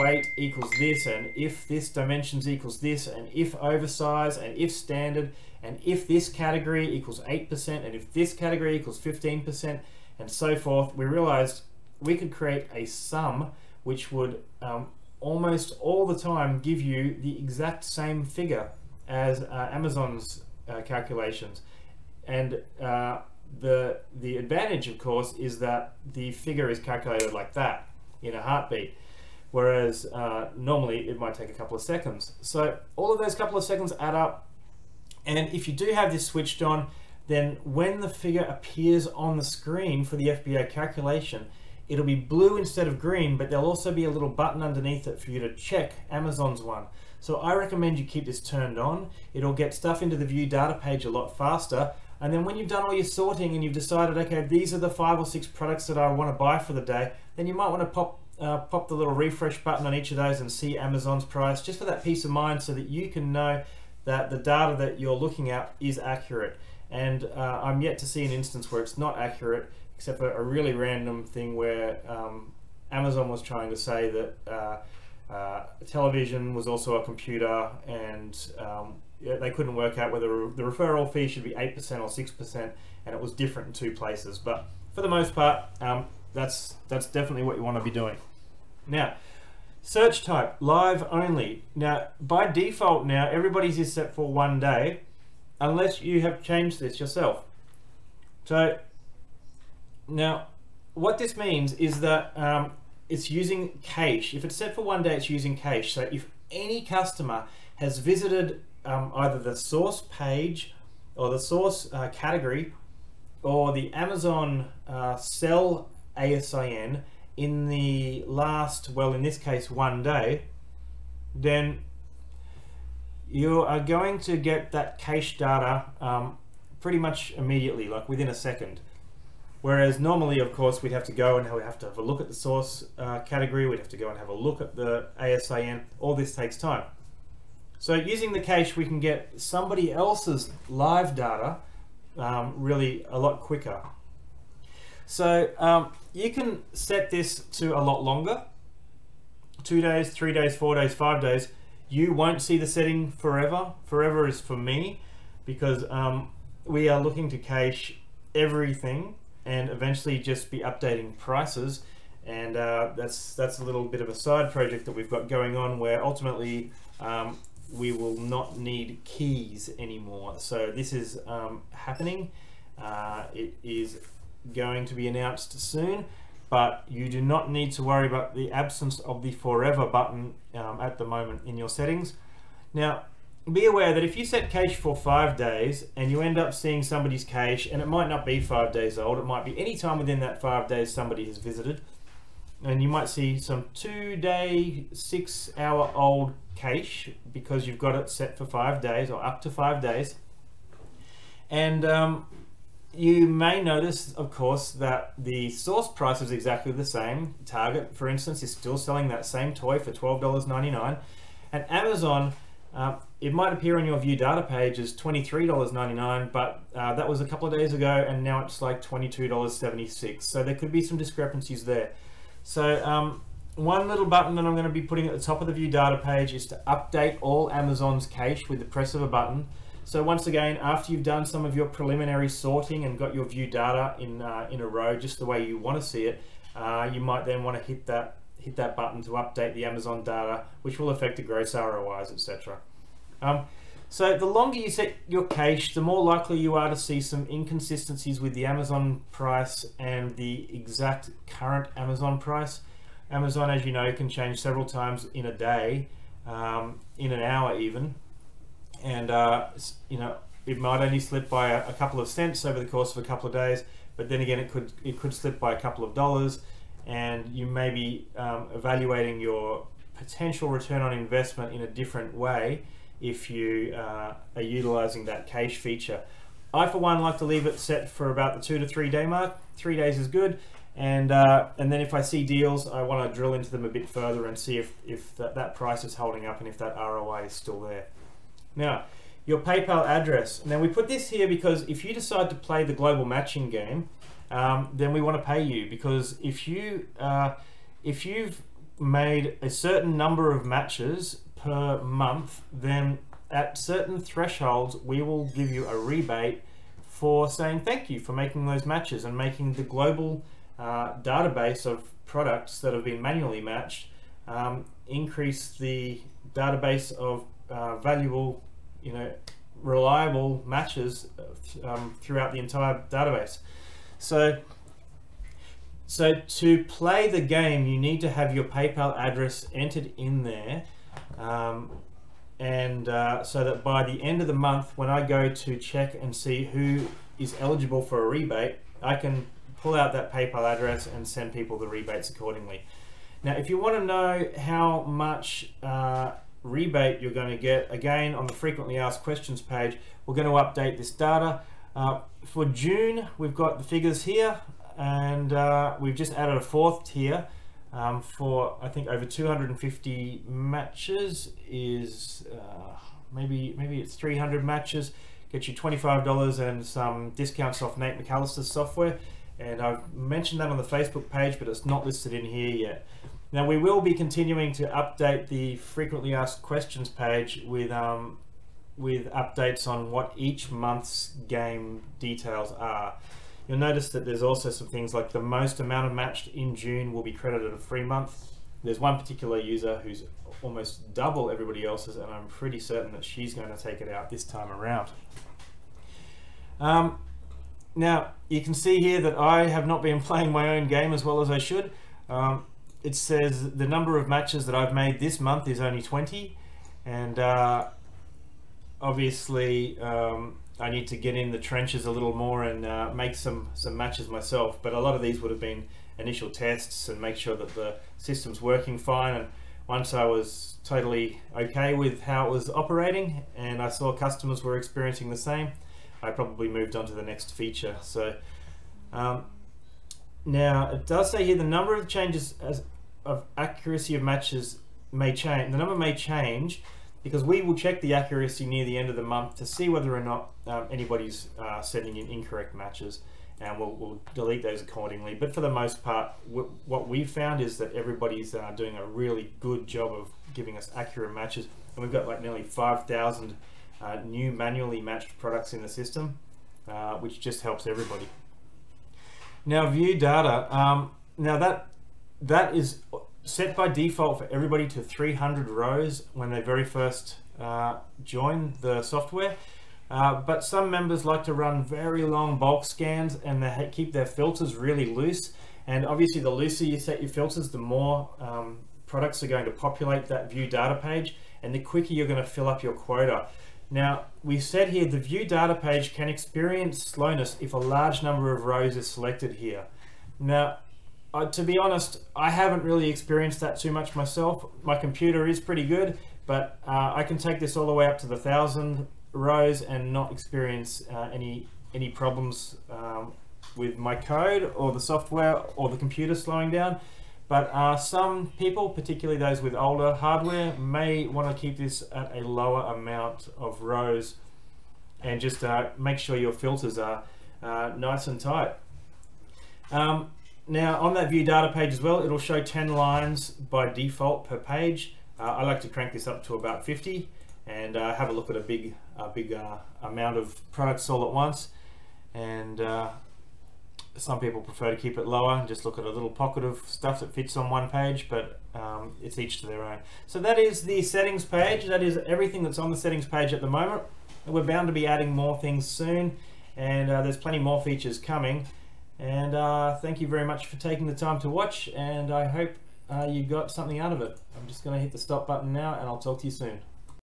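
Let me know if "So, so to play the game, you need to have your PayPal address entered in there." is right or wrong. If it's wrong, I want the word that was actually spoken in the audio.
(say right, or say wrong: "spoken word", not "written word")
right.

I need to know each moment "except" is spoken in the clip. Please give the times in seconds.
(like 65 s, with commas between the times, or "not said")
69 s.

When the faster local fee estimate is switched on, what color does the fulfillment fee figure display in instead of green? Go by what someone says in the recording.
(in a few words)
Blue.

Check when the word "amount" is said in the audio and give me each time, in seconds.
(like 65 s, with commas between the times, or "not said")
385 s, 512 s, 529 s.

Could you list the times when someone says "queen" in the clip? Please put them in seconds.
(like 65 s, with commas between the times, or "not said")
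not said.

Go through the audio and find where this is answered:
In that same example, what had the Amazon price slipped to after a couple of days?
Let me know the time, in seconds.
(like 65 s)
218 s.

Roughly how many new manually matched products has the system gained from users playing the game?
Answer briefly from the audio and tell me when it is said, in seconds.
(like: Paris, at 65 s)
Nearly 5,000, at 452 s.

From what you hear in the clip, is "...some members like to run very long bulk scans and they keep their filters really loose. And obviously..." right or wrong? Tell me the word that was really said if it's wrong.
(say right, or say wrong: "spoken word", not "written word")
right.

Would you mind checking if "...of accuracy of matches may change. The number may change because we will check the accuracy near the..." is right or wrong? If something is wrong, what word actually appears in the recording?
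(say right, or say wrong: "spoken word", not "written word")
right.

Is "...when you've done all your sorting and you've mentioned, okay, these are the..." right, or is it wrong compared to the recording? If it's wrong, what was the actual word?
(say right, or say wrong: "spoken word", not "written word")
wrong: "decided", not "mentioned".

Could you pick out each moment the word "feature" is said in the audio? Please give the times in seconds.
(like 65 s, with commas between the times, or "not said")
275 s, 427 s, 547 s.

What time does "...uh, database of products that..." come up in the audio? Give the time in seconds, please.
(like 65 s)
310 s.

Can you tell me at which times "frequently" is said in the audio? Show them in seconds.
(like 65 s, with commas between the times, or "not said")
348 s, 375 s.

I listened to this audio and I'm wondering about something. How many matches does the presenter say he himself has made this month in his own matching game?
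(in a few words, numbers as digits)
20.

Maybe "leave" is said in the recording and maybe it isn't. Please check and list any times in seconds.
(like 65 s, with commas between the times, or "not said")
277 s.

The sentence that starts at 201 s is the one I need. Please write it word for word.
And um, you may notice, of course, that the source price is exactly the same.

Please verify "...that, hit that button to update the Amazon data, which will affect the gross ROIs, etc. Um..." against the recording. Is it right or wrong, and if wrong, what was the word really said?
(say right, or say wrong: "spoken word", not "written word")
right.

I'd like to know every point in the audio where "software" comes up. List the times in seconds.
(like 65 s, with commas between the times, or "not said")
368 s, 468 s, 504 s.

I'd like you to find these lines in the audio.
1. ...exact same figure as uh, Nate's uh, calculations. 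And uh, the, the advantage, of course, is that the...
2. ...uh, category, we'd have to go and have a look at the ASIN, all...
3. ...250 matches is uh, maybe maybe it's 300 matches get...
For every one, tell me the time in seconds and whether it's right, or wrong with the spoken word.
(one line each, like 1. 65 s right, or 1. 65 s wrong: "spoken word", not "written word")
1. 17 s wrong: "Amazon", not "Nate"
2. 132 s right
3. 359 s right.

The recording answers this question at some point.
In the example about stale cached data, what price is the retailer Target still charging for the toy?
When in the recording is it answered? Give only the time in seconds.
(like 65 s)
209 s.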